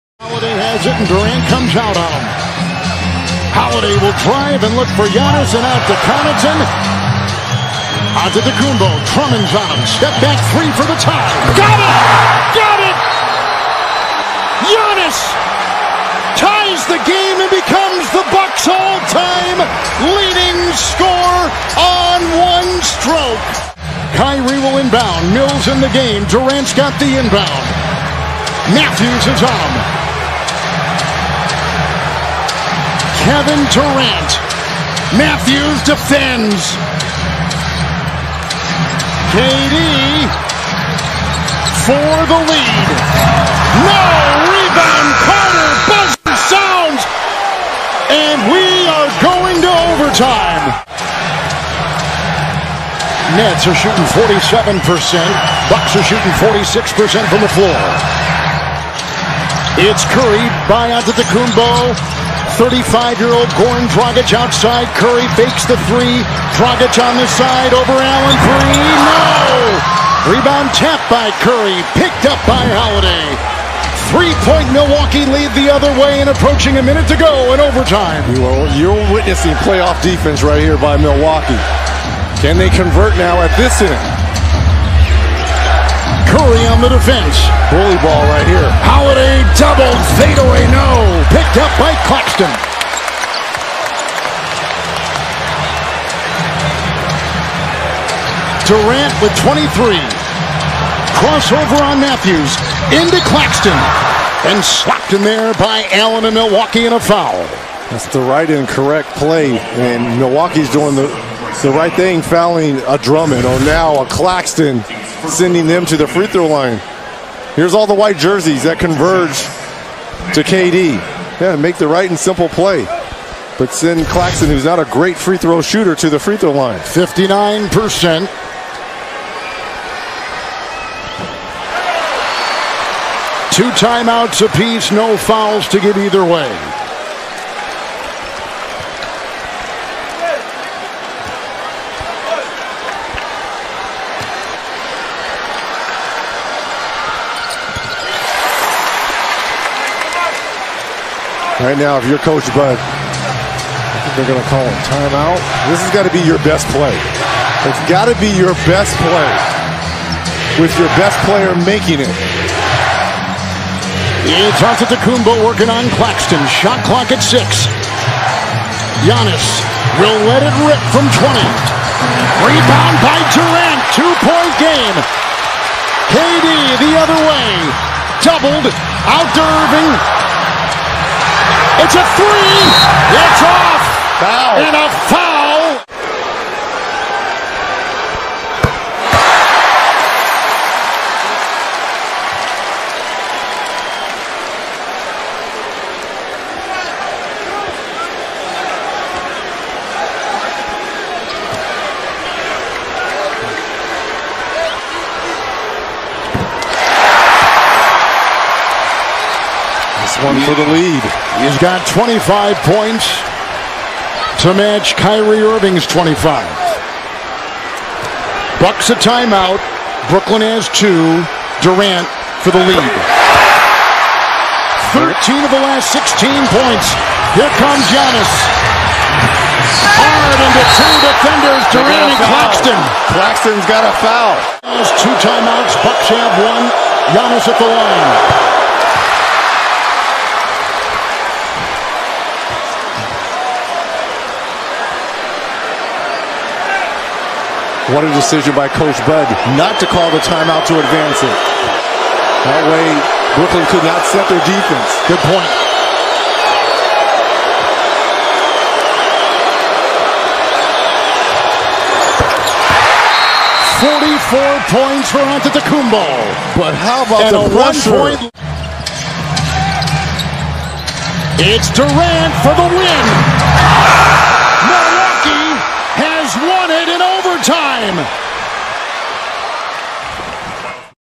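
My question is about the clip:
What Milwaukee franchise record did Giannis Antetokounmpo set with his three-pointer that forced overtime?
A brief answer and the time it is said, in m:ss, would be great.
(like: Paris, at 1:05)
All-time leading scorer, at 0:18.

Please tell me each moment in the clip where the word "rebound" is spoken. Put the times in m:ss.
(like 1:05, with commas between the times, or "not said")
0:44, 1:10, 2:52.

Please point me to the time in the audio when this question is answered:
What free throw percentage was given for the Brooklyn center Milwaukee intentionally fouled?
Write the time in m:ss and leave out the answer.
2:06.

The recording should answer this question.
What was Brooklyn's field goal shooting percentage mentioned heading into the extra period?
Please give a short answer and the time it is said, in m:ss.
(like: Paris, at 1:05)
47%, at 0:54.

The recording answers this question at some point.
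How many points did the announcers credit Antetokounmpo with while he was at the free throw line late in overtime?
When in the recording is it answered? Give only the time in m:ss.
4:23.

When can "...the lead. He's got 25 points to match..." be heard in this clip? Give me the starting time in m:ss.
3:30.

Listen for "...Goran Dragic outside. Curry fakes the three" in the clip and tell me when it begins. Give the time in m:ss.
1:03.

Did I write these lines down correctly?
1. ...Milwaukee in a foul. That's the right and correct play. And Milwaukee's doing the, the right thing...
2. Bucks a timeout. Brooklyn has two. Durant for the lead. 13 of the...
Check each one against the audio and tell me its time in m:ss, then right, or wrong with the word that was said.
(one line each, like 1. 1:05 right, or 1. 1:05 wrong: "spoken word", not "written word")
1. 1:46 right
2. 3:38 right.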